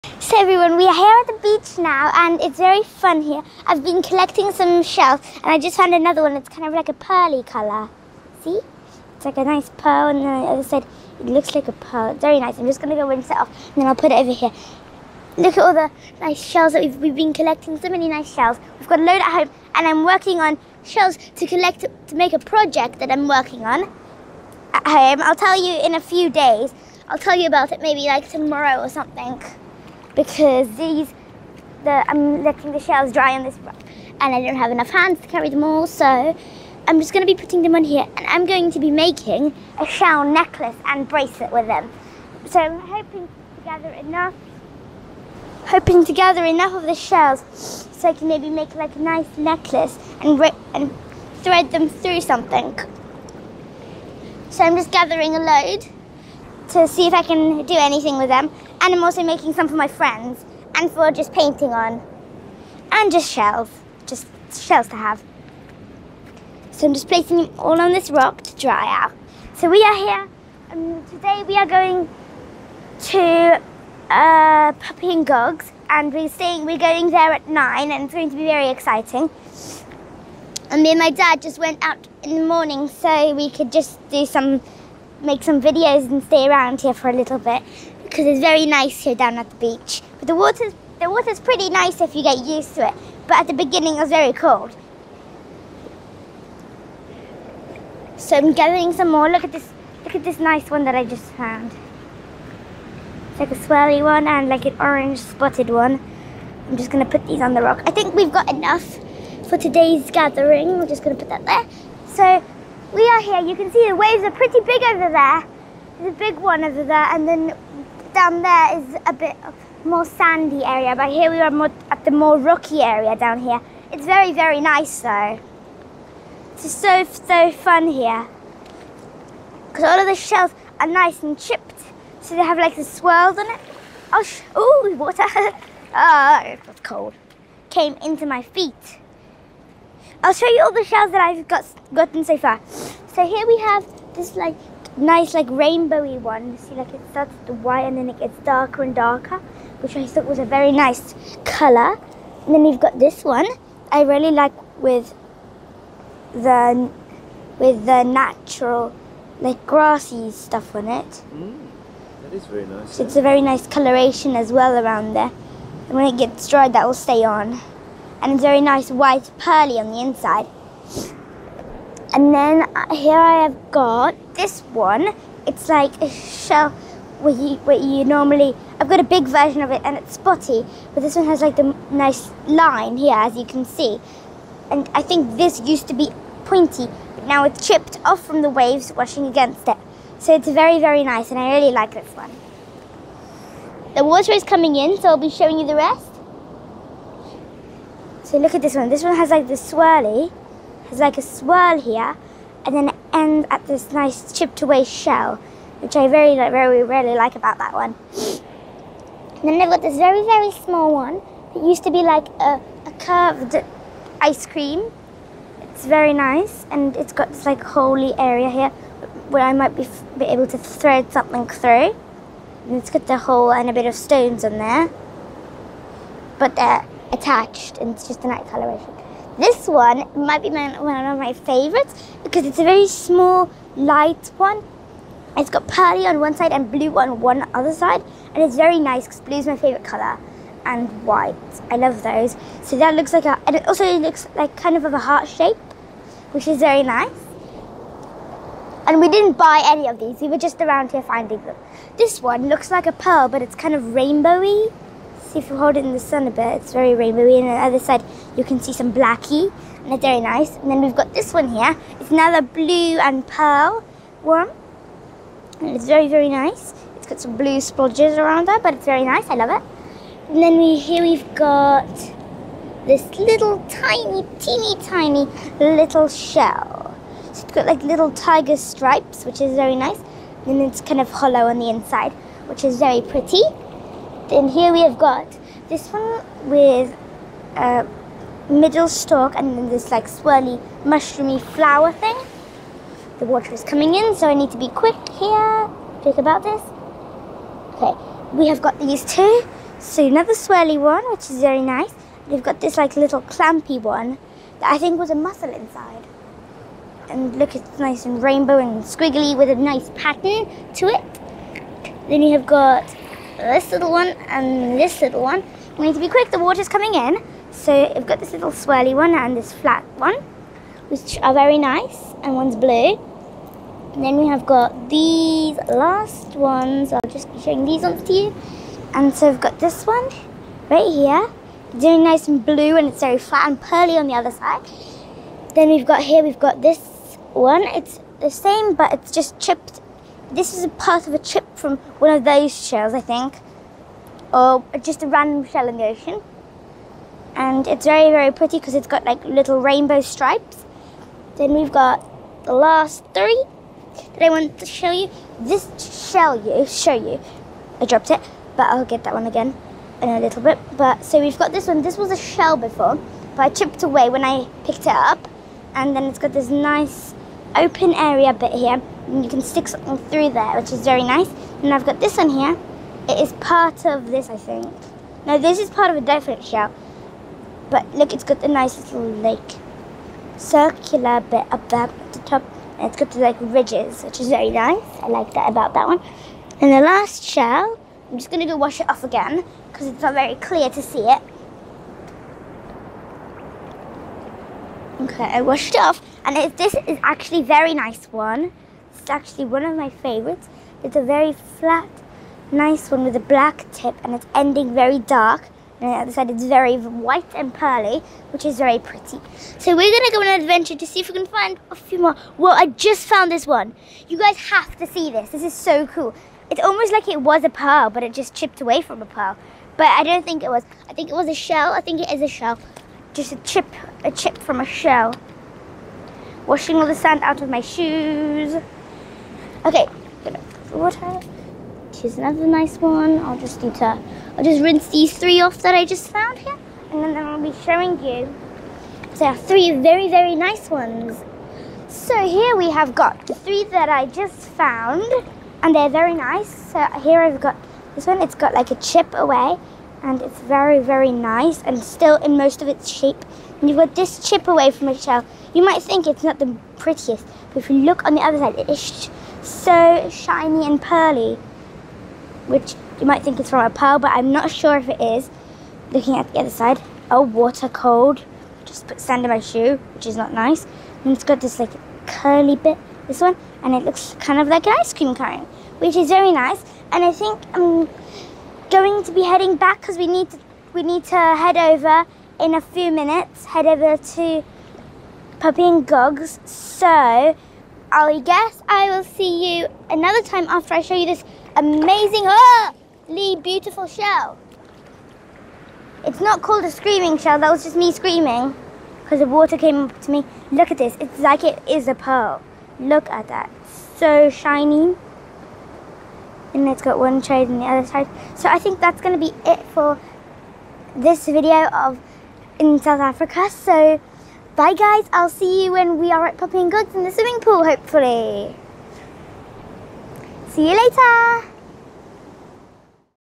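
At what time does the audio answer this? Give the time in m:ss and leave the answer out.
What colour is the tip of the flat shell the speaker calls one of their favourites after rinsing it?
6:43.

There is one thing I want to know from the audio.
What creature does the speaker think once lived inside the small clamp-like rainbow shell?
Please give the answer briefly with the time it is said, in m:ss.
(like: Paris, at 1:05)
A mussel, at 5:05.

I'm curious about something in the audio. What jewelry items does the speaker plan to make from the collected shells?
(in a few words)
Necklace and bracelet.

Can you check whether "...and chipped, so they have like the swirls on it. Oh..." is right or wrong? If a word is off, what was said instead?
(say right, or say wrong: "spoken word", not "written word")
right.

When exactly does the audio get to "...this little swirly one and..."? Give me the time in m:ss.
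5:18.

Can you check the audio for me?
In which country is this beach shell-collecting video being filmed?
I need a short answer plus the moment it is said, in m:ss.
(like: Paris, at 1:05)
South Africa, at 8:32.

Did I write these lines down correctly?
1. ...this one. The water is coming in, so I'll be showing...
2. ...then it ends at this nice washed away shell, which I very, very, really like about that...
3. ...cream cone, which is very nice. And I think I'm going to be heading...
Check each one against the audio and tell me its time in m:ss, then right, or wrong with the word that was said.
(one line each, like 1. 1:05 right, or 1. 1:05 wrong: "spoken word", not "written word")
1. 3:11 right
2. 3:22 wrong: "chipped", not "washed"
3. 7:54 right.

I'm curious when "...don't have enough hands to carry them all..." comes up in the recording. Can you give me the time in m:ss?
0:34.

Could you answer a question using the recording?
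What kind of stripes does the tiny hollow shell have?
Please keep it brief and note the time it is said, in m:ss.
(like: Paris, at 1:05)
Tiger stripes, at 4:38.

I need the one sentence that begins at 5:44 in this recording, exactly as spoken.
Or just a random shell in the ocean.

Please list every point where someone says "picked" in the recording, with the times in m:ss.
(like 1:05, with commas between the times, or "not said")
6:04.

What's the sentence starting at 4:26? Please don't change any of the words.
It's got some blue splodges around it, but it's very nice.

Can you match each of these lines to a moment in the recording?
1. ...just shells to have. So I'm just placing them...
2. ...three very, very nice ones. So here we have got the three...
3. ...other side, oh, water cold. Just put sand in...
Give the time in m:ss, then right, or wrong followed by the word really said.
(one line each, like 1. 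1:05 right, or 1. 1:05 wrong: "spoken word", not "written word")
1. 1:04 right
2. 7:19 right
3. 7:46 right.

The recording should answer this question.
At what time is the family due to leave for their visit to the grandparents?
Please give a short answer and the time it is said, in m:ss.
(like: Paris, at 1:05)
9, at 1:17.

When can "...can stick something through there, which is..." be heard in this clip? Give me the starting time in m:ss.
6:09.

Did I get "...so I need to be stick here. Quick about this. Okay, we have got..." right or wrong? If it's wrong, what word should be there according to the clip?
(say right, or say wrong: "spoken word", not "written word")
wrong: "quick", not "stick".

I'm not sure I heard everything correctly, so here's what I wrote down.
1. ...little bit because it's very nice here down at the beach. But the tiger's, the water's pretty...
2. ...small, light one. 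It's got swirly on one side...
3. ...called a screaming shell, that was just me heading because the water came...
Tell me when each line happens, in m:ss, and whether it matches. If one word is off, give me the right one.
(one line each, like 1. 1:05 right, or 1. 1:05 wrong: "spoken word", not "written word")
1. 1:27 wrong: "water", not "tiger"
2. 3:52 wrong: "pearly", not "swirly"
3. 8:16 wrong: "screaming", not "heading".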